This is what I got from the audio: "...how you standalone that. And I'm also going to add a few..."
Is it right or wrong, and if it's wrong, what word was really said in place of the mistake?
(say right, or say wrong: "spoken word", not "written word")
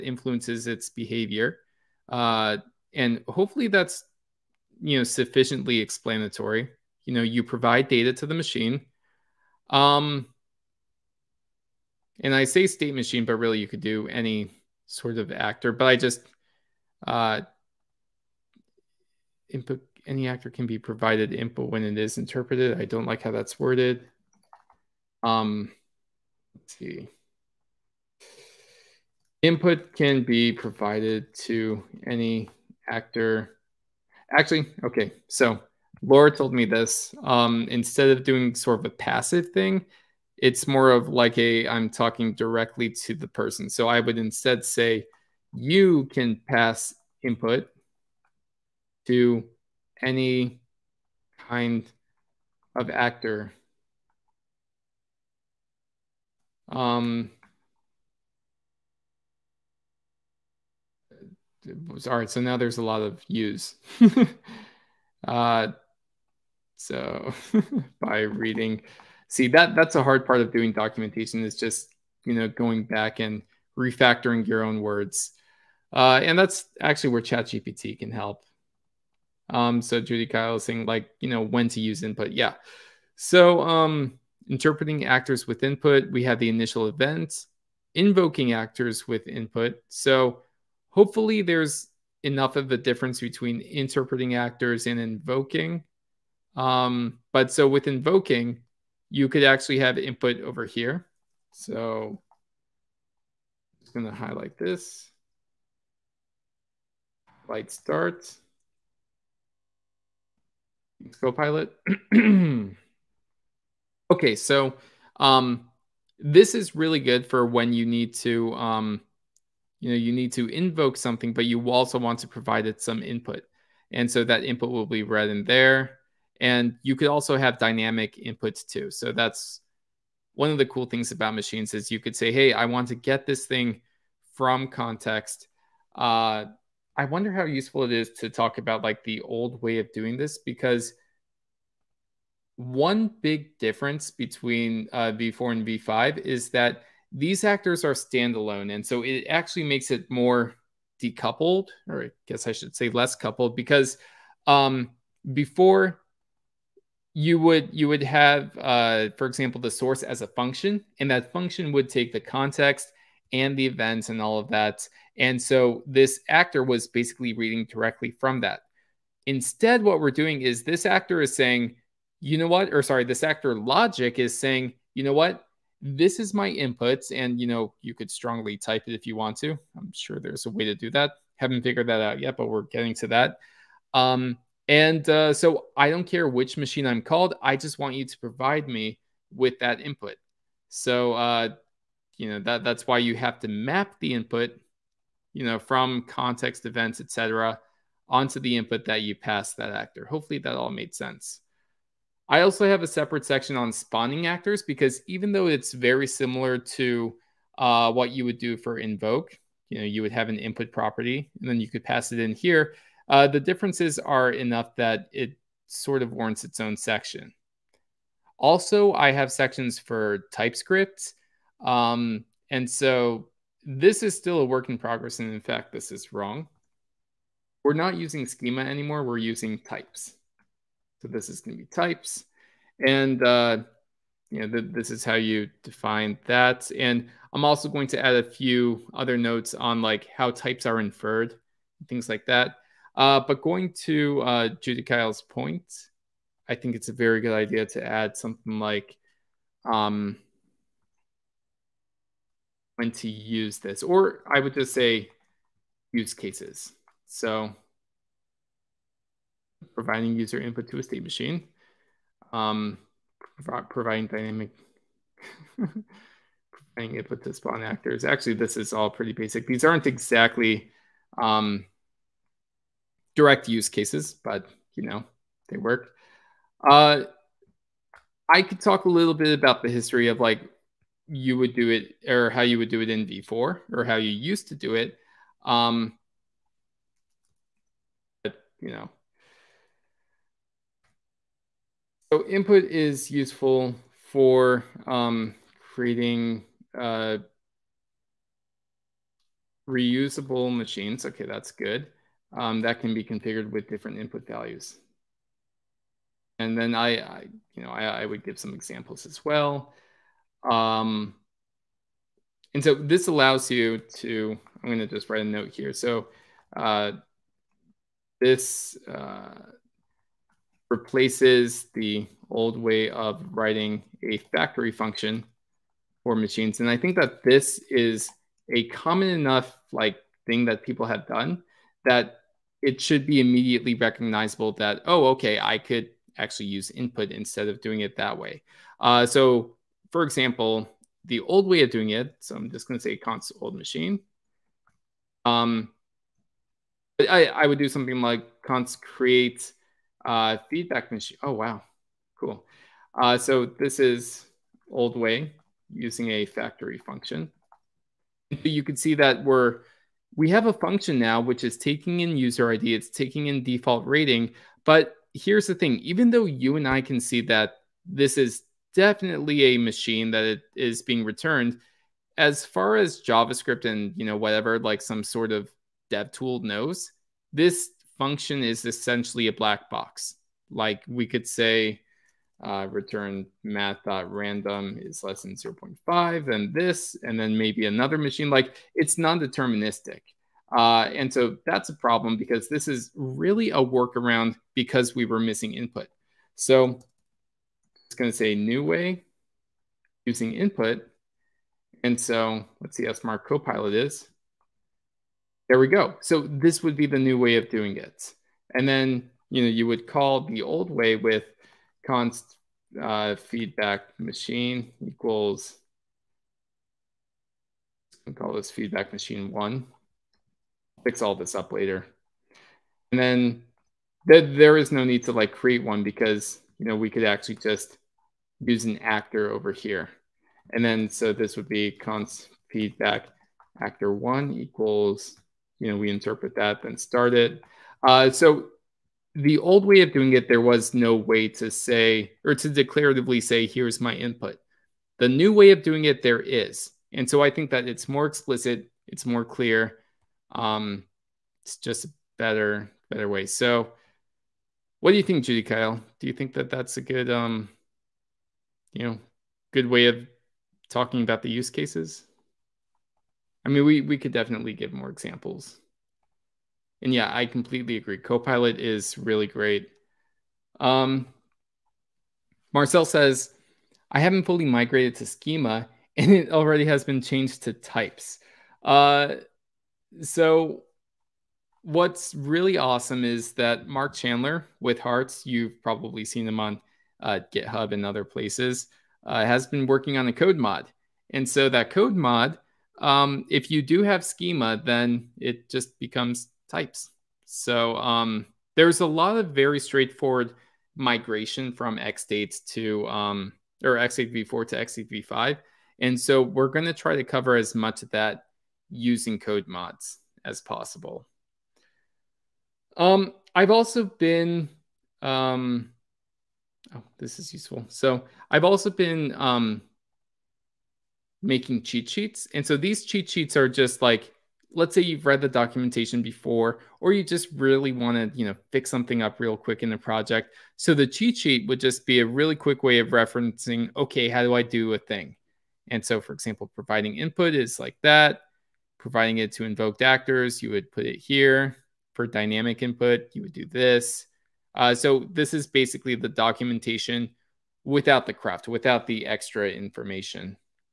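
wrong: "define", not "standalone".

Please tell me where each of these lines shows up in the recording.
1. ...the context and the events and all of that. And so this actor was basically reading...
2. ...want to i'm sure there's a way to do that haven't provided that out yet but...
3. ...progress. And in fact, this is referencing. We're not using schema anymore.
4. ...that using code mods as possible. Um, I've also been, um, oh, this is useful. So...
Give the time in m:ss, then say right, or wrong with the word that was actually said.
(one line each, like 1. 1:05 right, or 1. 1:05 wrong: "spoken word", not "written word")
1. 2:42 right
2. 2:59 wrong: "figured", not "provided"
3. 3:44 wrong: "wrong", not "referencing"
4. 8:27 right.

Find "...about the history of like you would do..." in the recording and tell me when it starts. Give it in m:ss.
4:39.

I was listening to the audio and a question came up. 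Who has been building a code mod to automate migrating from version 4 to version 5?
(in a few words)
Mark Chandler.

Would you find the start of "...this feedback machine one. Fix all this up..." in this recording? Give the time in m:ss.
6:58.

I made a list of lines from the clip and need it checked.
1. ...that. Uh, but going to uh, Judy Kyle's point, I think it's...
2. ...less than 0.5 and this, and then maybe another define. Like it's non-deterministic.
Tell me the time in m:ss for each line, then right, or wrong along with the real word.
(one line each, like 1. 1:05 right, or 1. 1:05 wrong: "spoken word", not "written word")
1. 4:02 right
2. 6:25 wrong: "machine", not "define".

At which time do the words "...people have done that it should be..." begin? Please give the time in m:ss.
5:30.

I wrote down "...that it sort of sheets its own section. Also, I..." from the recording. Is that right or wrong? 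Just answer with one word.
wrong.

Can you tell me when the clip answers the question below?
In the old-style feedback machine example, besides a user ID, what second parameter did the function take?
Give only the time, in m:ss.
6:03.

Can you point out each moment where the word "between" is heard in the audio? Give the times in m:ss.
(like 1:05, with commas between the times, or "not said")
1:33, 2:24.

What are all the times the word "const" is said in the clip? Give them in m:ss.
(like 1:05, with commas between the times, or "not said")
5:42, 5:48, 6:51, 7:11.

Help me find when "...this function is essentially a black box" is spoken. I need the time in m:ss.
6:17.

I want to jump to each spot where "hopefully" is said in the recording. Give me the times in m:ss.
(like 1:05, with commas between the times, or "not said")
0:03, 1:30, 3:20.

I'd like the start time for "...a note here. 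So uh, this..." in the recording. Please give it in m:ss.
5:15.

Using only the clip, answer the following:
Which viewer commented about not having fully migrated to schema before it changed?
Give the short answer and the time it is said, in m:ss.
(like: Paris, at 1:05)
Marcel, at 7:52.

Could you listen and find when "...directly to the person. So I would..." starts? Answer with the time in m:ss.
0:42.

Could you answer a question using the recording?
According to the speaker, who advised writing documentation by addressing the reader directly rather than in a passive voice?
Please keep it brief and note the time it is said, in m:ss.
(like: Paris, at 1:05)
Laura, at 0:36.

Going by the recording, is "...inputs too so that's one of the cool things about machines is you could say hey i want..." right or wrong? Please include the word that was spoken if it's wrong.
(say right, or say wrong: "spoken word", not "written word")
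right.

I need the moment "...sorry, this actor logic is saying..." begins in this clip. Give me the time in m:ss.
2:52.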